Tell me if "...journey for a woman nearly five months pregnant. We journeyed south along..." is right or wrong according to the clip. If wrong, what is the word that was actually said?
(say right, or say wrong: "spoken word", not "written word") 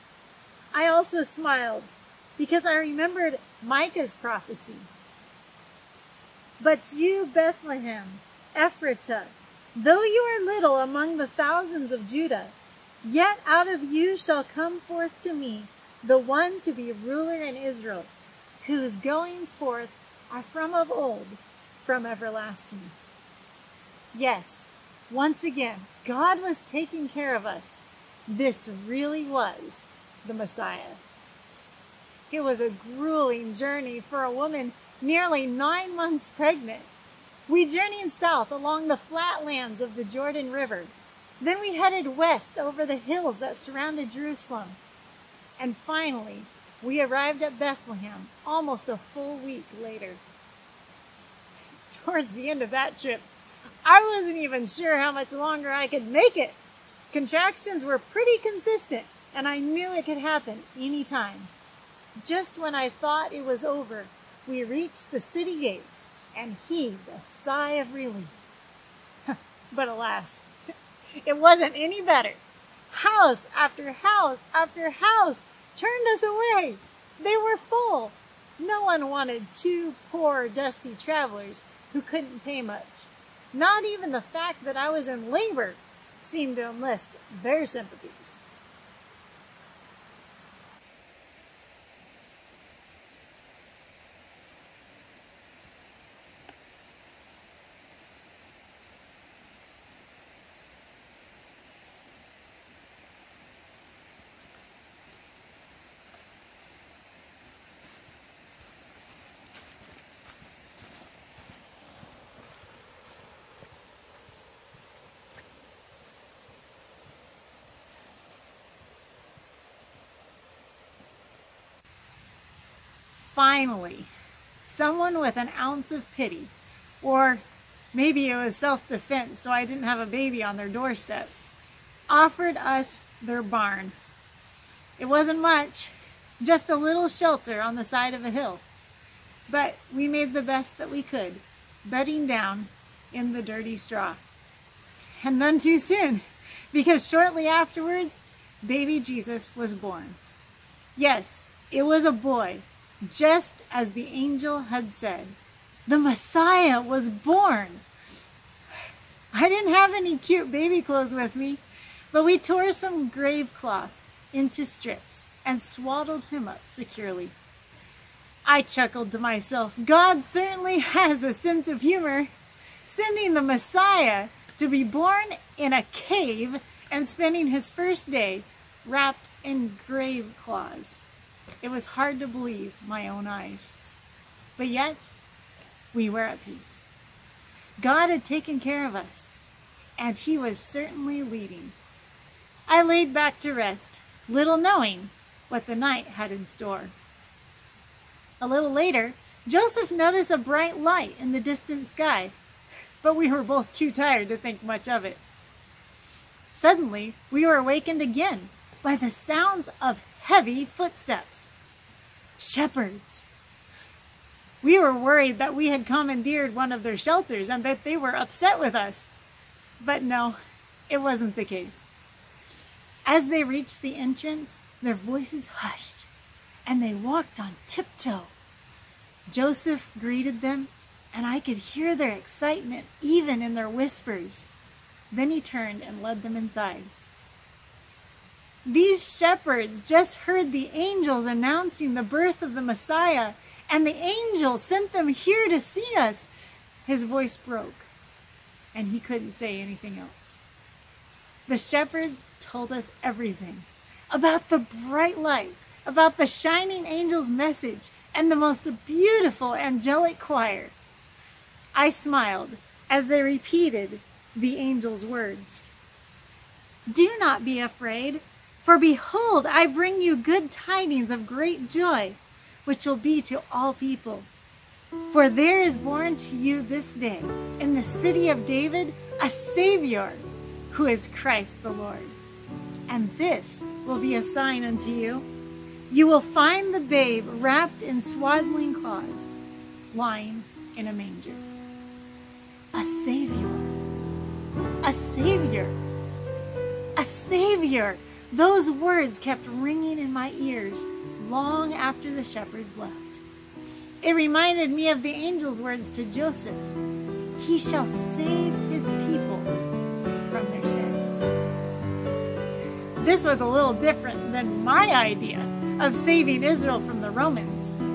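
wrong: "nine", not "five".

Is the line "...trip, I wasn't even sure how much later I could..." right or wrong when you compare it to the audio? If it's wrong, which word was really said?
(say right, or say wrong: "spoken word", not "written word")
wrong: "longer", not "later".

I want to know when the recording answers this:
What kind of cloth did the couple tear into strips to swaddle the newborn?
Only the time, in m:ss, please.
2:43.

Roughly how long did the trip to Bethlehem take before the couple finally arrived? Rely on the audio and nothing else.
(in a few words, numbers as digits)
almost a full week.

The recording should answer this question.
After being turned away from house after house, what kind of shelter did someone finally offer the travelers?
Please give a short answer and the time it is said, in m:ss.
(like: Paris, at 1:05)
barn, at 2:13.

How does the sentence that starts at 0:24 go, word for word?
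Yes, once again, God was taking care of us.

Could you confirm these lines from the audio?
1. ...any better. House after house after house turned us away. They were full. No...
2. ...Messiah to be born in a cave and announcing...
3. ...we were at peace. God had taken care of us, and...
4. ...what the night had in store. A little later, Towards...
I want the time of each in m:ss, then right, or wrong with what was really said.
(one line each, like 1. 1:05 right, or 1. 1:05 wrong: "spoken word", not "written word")
1. 1:11 right
2. 2:53 wrong: "spending", not "announcing"
3. 3:05 right
4. 3:15 wrong: "Joseph", not "Towards".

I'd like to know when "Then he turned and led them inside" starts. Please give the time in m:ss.
3:55.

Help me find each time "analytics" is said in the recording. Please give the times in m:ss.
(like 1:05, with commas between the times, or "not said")
not said.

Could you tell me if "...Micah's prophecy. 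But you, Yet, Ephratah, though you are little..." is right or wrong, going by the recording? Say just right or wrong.
wrong.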